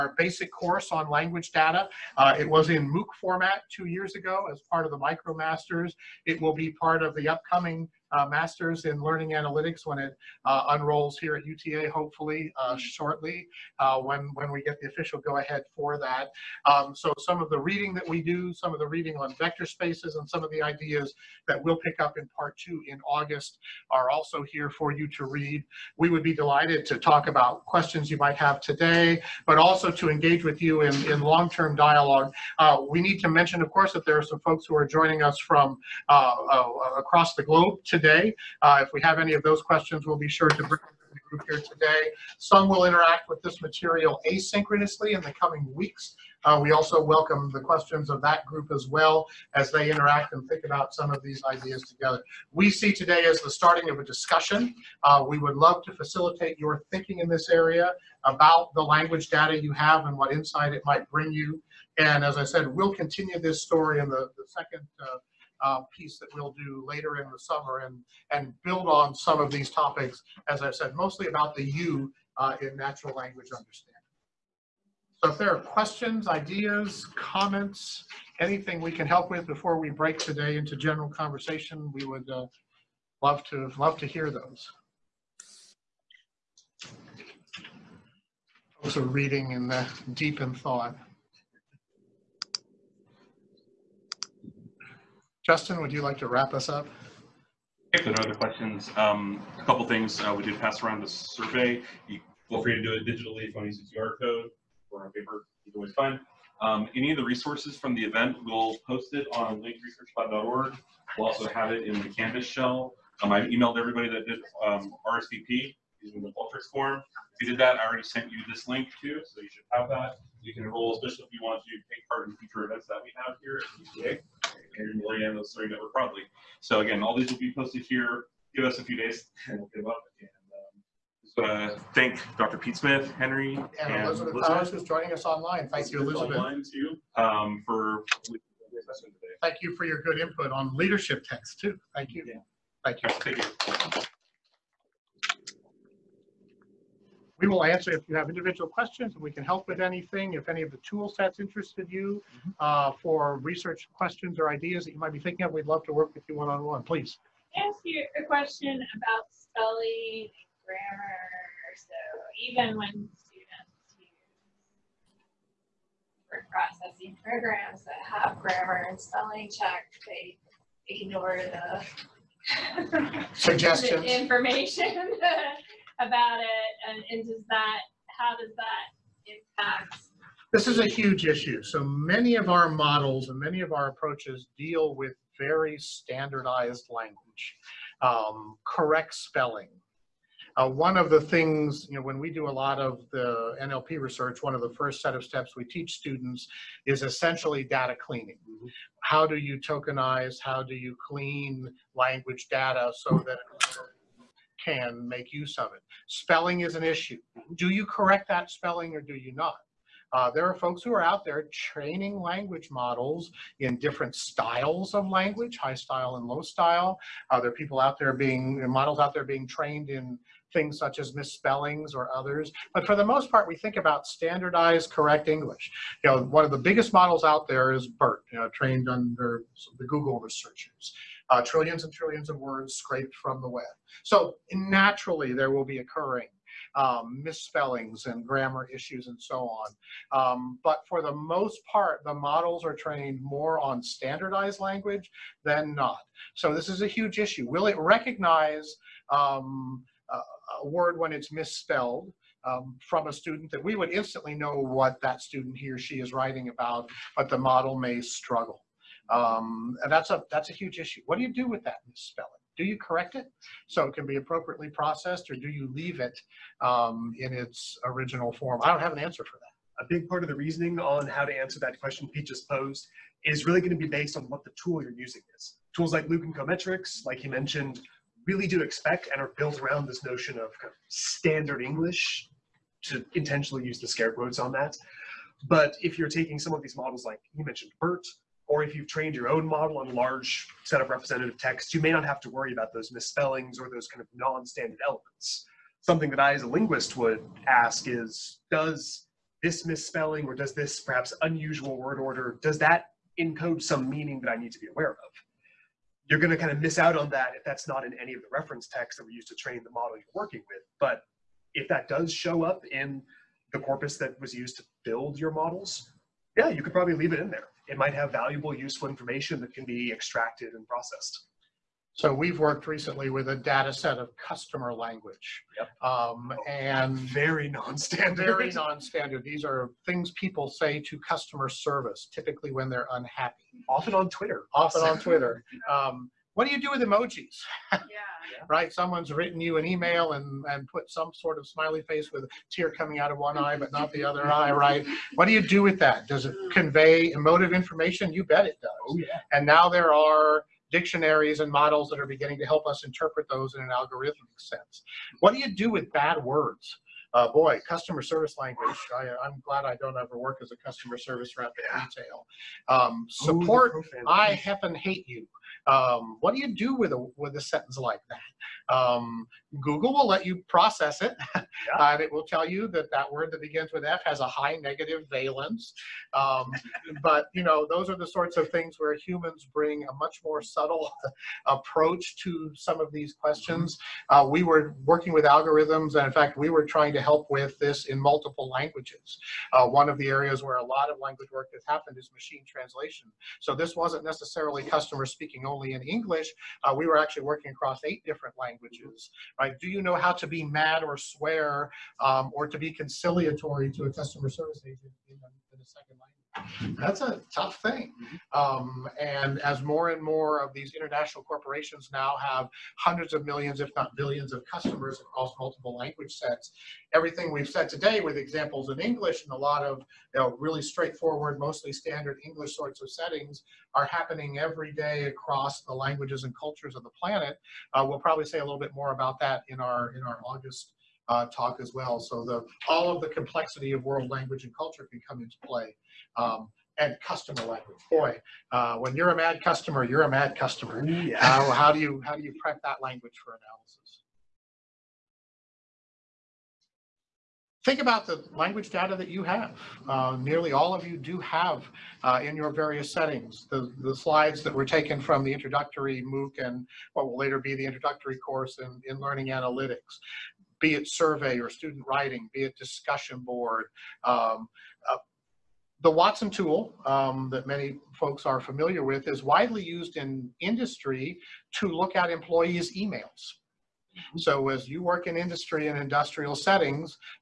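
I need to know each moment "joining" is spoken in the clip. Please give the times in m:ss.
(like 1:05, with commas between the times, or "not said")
0:34, 2:14.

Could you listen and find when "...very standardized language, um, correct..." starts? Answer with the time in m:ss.
3:05.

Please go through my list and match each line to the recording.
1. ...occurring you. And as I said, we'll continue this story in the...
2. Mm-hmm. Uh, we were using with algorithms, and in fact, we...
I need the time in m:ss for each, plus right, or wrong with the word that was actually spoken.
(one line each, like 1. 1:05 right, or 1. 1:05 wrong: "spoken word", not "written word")
1. 1:01 wrong: "bring", not "occurring"
2. 6:24 wrong: "working", not "using".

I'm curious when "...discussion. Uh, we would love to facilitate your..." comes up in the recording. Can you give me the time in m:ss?
0:54.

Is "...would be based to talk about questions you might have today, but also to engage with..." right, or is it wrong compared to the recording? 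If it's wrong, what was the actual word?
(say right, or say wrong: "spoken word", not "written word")
wrong: "delighted", not "based".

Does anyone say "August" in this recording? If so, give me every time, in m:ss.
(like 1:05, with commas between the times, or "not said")
0:23, 7:10.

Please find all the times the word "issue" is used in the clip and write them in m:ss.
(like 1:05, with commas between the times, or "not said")
3:01, 3:26, 3:58, 4:07, 4:20.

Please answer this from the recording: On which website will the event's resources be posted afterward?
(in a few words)
linkresearchlab.org.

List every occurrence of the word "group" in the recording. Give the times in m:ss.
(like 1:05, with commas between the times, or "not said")
0:41, 0:48.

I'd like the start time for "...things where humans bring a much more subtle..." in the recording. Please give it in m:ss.
6:18.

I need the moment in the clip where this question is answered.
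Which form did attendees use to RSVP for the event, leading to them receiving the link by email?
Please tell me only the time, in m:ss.
1:56.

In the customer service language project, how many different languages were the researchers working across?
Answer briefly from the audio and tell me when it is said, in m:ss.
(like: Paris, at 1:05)
8, at 6:37.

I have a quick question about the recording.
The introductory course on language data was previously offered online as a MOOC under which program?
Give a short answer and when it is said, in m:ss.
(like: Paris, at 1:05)
MicroMasters, at 0:04.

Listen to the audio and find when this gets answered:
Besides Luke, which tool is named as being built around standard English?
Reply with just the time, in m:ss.
4:36.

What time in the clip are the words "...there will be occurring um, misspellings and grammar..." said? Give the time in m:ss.
3:55.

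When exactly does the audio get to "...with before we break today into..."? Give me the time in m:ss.
1:19.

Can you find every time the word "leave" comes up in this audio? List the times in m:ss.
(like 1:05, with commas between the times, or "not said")
4:25, 5:16.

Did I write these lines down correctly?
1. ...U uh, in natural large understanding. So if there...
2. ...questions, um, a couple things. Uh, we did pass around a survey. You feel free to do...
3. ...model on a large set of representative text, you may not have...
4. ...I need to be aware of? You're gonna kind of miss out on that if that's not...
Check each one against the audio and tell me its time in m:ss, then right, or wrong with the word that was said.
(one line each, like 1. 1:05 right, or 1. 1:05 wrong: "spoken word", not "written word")
1. 1:11 wrong: "language", not "large"
2. 1:38 right
3. 4:49 right
4. 5:04 right.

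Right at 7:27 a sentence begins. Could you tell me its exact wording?
Think about the language data that you have.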